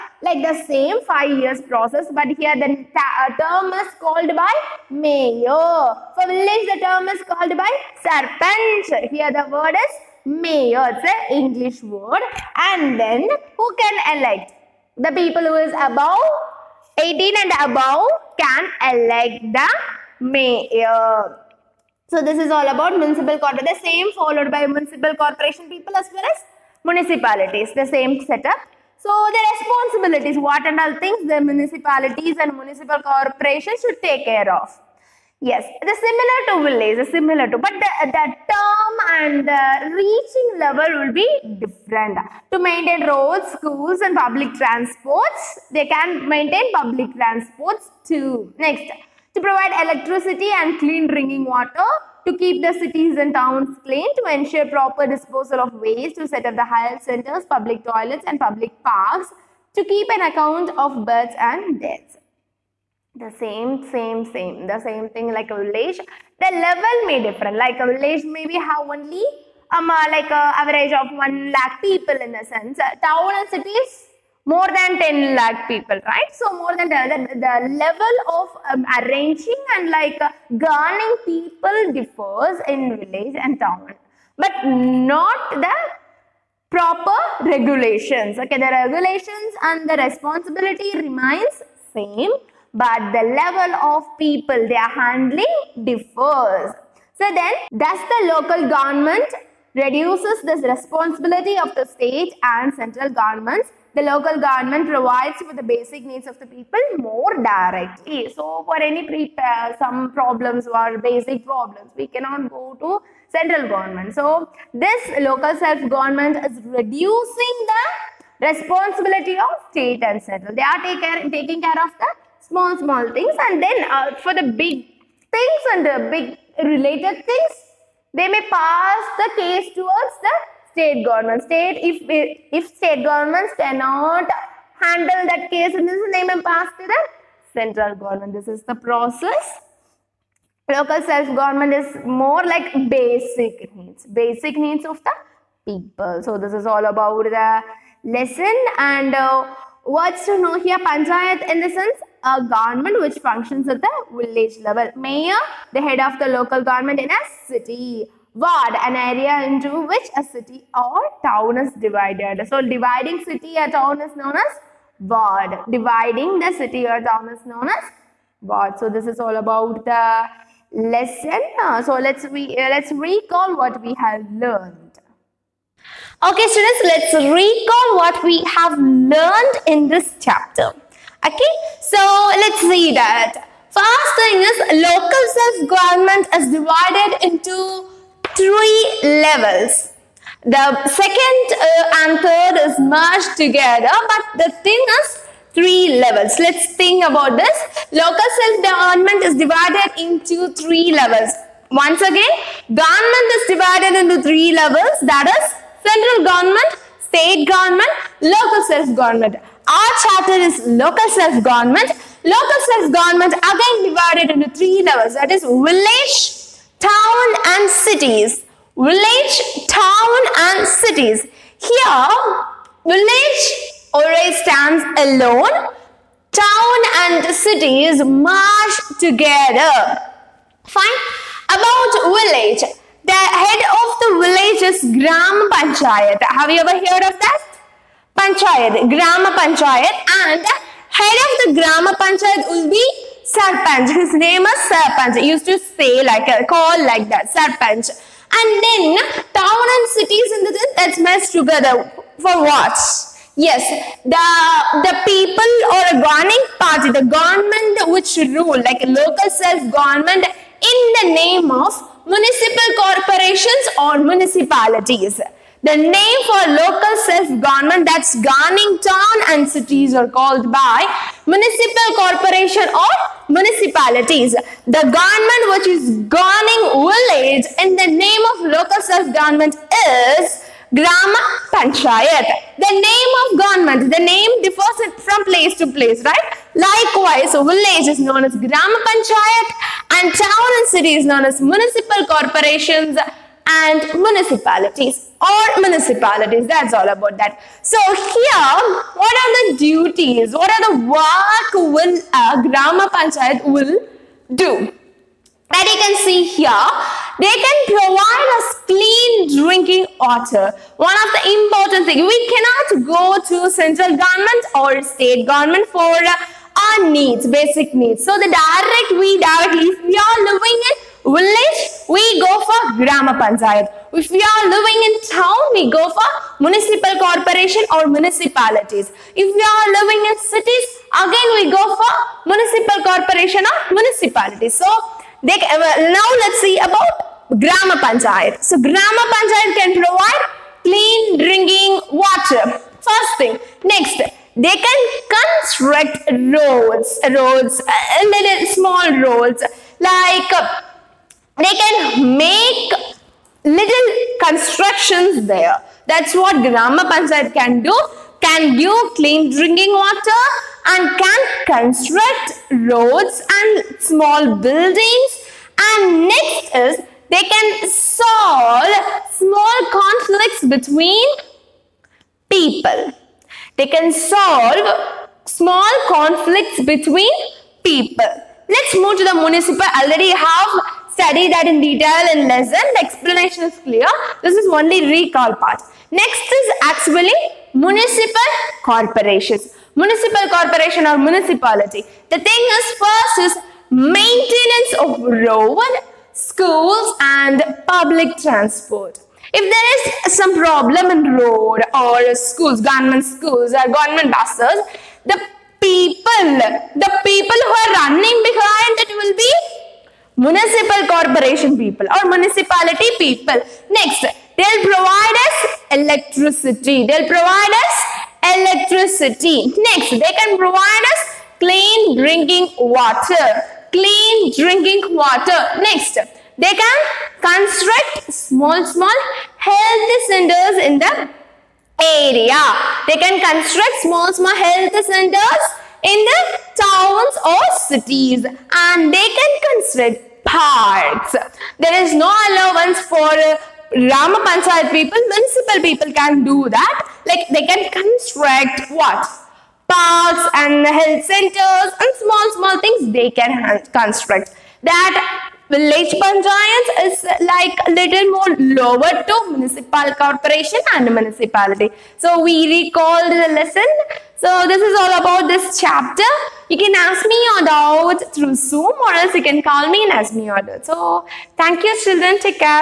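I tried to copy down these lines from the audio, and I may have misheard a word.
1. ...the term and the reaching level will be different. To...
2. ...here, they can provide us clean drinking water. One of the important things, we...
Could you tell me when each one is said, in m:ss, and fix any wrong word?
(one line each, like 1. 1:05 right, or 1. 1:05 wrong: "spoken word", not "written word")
1. 0:38 right
2. 5:06 right.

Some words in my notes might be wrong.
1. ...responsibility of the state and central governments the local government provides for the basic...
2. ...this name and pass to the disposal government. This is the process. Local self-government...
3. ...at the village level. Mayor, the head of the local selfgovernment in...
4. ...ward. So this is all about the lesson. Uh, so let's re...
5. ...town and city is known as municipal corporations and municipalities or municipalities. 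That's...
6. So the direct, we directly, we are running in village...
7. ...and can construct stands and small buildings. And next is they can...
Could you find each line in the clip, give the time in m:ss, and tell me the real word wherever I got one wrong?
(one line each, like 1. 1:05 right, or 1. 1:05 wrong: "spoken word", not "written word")
1. 1:40 right
2. 2:15 wrong: "central", not "disposal"
3. 2:33 wrong: "government", not "selfgovernment"
4. 2:48 right
5. 4:50 right
6. 5:18 wrong: "living", not "running"
7. 6:00 wrong: "roads", not "stands".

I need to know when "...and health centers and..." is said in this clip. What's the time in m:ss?
7:30.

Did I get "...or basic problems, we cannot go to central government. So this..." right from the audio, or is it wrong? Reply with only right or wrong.
right.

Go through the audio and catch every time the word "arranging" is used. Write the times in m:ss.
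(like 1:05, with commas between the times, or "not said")
1:18.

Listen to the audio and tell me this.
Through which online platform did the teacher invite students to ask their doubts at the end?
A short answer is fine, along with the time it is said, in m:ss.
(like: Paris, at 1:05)
Zoom, at 7:48.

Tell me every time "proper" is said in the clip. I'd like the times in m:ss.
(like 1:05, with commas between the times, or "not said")
0:54, 1:26.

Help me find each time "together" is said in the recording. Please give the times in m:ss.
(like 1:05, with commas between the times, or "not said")
3:13, 3:48, 4:11.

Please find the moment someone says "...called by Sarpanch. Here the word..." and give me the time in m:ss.
0:07.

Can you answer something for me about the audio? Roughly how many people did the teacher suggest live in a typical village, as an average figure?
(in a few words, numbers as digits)
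1 lakh.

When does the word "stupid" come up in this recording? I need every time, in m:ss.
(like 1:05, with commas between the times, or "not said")
not said.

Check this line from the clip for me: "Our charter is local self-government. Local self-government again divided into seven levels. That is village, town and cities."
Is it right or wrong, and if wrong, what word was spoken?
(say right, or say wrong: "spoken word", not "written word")
wrong: "three", not "seven".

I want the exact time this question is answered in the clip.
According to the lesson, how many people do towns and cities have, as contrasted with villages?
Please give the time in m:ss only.
1:14.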